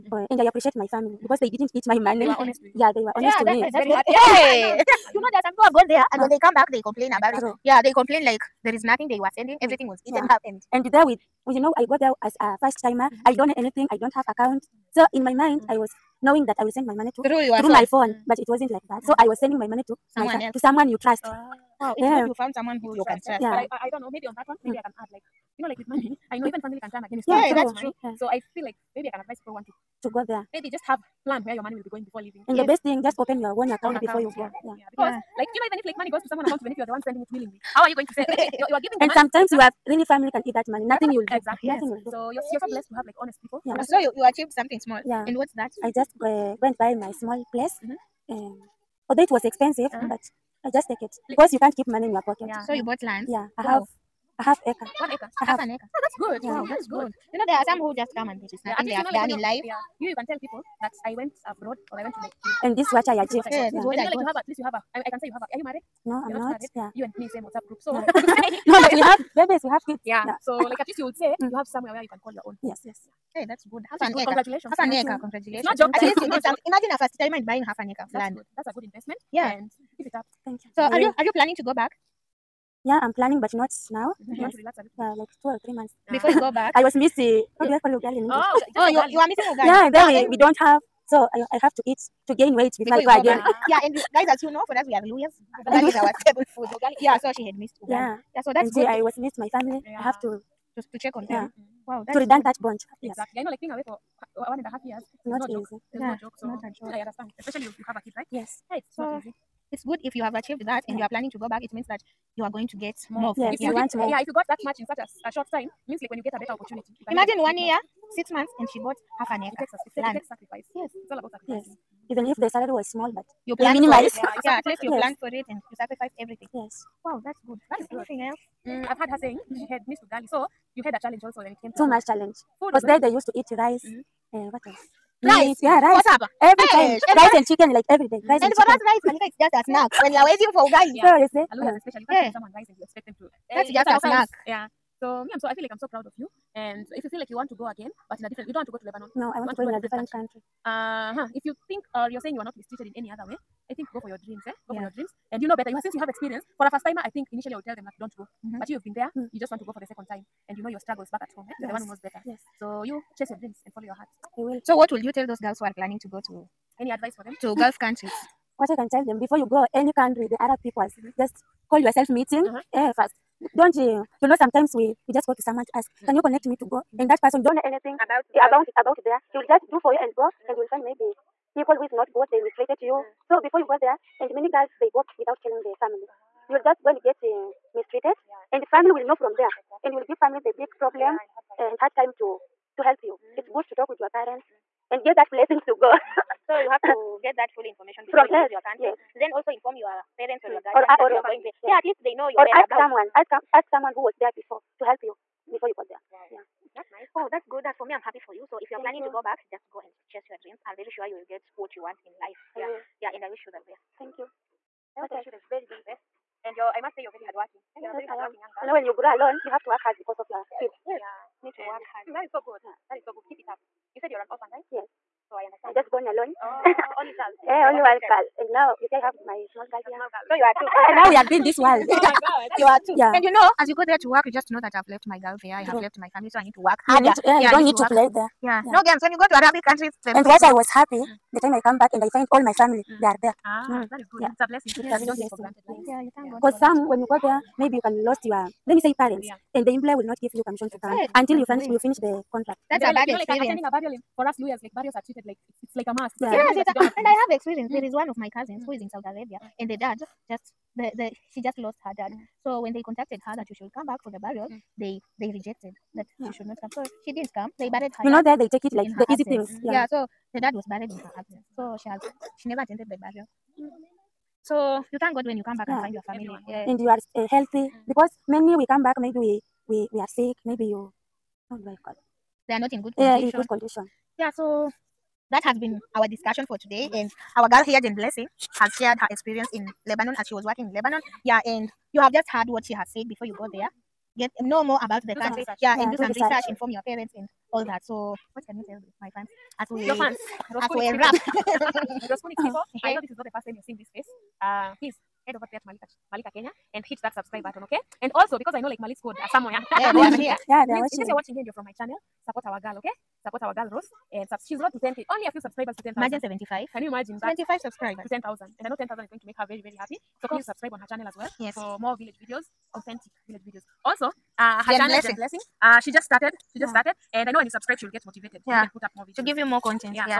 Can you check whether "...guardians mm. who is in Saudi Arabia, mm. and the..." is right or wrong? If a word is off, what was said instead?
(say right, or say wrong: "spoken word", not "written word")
wrong: "cousins", not "guardians".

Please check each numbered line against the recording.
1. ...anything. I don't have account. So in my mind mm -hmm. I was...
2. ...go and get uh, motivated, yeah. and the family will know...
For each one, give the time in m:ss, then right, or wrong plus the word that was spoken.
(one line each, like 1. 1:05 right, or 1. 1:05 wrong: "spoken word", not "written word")
1. 0:13 right
2. 3:06 wrong: "mistreated", not "motivated".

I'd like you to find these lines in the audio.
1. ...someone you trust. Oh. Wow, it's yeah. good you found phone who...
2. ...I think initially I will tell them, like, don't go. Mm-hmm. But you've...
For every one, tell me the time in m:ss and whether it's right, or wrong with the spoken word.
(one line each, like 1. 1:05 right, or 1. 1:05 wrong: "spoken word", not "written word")
1. 0:20 wrong: "someone", not "phone"
2. 2:37 right.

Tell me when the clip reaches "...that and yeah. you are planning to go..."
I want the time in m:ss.
1:50.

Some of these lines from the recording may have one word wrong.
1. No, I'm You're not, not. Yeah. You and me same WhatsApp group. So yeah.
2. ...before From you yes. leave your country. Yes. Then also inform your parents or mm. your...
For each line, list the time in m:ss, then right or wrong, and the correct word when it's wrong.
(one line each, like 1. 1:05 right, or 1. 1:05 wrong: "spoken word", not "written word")
1. 1:06 right
2. 3:18 right.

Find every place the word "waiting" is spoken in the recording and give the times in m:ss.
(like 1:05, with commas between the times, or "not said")
2:20.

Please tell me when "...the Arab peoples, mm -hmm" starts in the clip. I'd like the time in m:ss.
2:50.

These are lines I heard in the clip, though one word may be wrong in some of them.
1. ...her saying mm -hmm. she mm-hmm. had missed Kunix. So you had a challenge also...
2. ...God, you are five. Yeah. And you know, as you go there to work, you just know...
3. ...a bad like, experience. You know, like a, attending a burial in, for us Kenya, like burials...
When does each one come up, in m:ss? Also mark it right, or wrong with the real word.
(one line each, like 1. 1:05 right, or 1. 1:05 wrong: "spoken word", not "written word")
1. 2:09 wrong: "Ugali", not "Kunix"
2. 3:52 wrong: "two", not "five"
3. 4:12 wrong: "Luhyas", not "Kenya".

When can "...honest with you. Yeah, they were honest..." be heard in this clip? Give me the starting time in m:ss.
0:02.